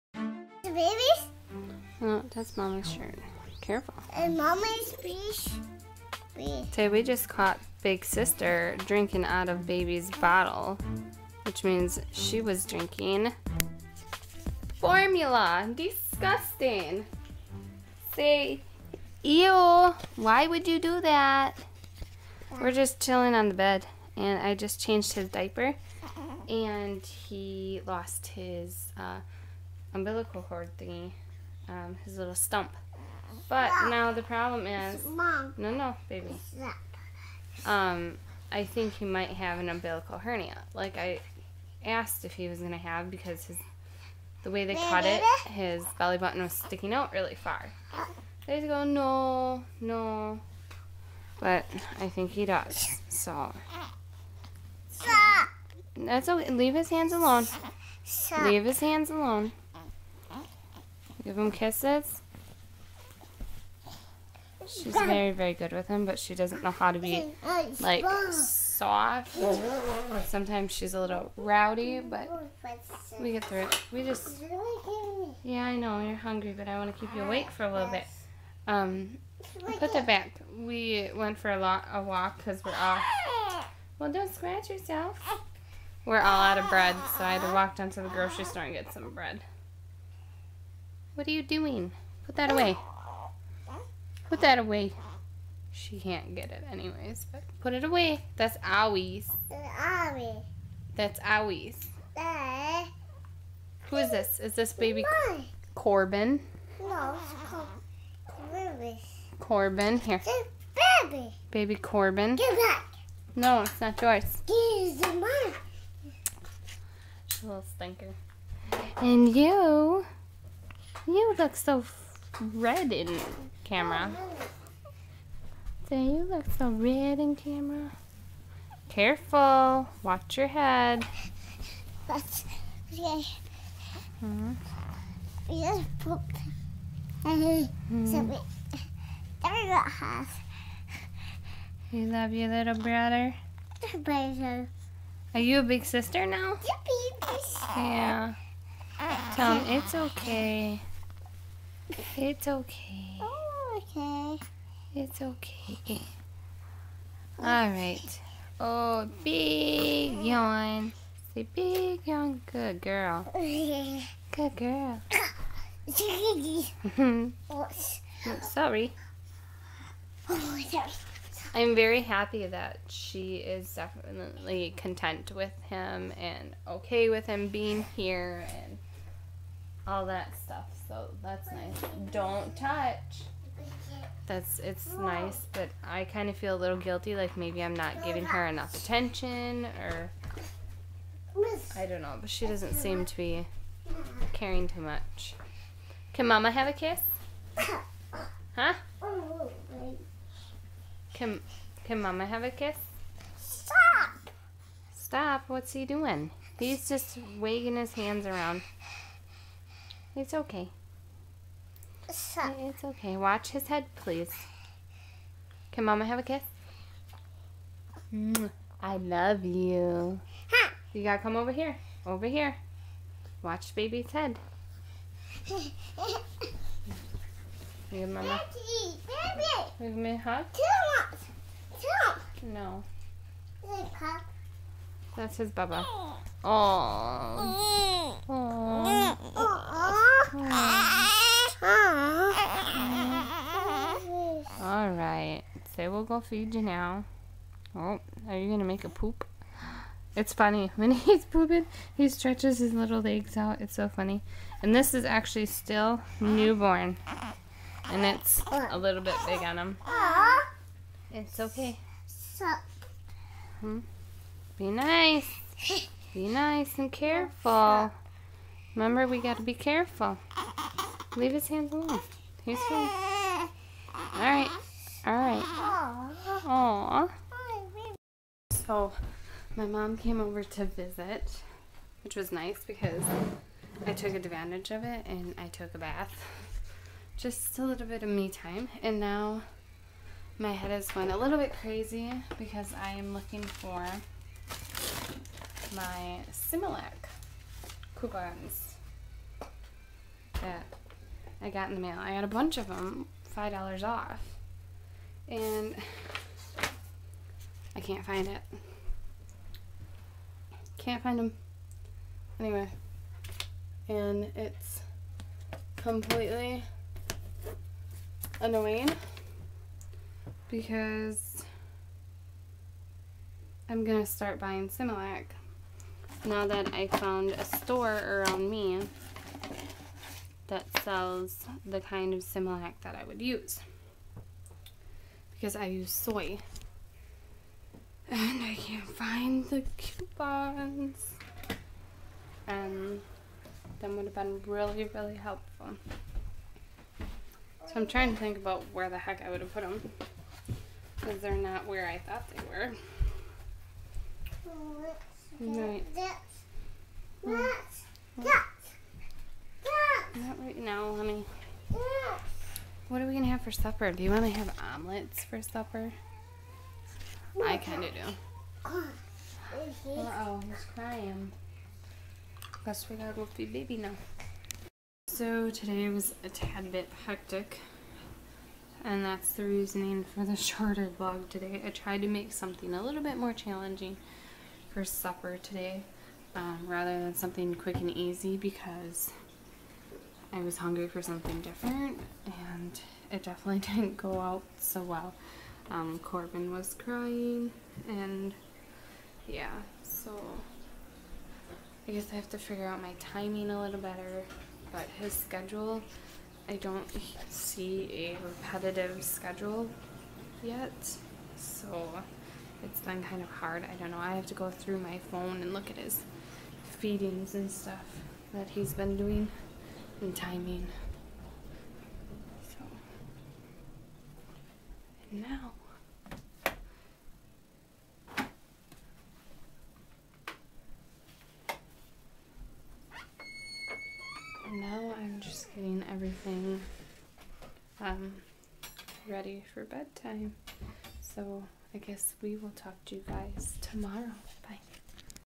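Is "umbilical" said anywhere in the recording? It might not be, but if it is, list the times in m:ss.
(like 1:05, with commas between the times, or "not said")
0:29, 0:39.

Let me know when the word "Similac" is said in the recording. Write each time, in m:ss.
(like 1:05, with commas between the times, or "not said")
4:56, 5:24, 5:32.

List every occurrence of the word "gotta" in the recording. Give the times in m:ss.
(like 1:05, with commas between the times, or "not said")
3:41, 6:12.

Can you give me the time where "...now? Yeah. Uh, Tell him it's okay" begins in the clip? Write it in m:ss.
2:26.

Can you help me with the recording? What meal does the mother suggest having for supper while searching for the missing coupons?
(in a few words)
Omelets.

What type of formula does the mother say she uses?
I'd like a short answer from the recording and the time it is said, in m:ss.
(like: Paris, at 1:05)
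Soy, at 5:35.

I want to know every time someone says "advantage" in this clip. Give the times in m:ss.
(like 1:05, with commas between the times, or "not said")
4:44.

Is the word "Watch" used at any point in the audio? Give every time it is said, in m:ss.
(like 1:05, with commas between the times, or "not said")
2:10, 3:33, 3:43.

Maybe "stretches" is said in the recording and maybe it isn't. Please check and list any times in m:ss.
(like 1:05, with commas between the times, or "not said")
4:12.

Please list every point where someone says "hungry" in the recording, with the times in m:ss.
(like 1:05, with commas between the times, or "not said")
1:16, 6:30.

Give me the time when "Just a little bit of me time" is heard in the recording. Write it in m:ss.
4:47.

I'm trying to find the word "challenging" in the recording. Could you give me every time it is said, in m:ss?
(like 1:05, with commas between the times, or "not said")
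6:23.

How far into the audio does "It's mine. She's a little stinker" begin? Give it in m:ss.
1:54.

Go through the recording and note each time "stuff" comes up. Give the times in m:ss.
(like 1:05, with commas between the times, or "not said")
3:00, 6:57.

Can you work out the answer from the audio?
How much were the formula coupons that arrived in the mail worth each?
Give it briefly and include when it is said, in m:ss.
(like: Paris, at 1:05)
$5 off, at 5:03.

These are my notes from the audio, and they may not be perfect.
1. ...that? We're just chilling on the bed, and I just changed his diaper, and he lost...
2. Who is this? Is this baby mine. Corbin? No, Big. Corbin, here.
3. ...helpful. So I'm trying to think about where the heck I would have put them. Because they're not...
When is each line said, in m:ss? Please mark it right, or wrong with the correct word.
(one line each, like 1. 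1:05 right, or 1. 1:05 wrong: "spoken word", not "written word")
1. 0:21 right
2. 1:43 wrong: "Corbin", not "Big"
3. 5:45 right.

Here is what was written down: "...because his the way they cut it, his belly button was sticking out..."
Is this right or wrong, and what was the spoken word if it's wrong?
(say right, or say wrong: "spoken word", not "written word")
right.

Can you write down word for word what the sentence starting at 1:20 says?
We went for a, lot, a walk because we're off.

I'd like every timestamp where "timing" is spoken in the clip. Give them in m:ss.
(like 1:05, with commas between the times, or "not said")
6:42, 7:00.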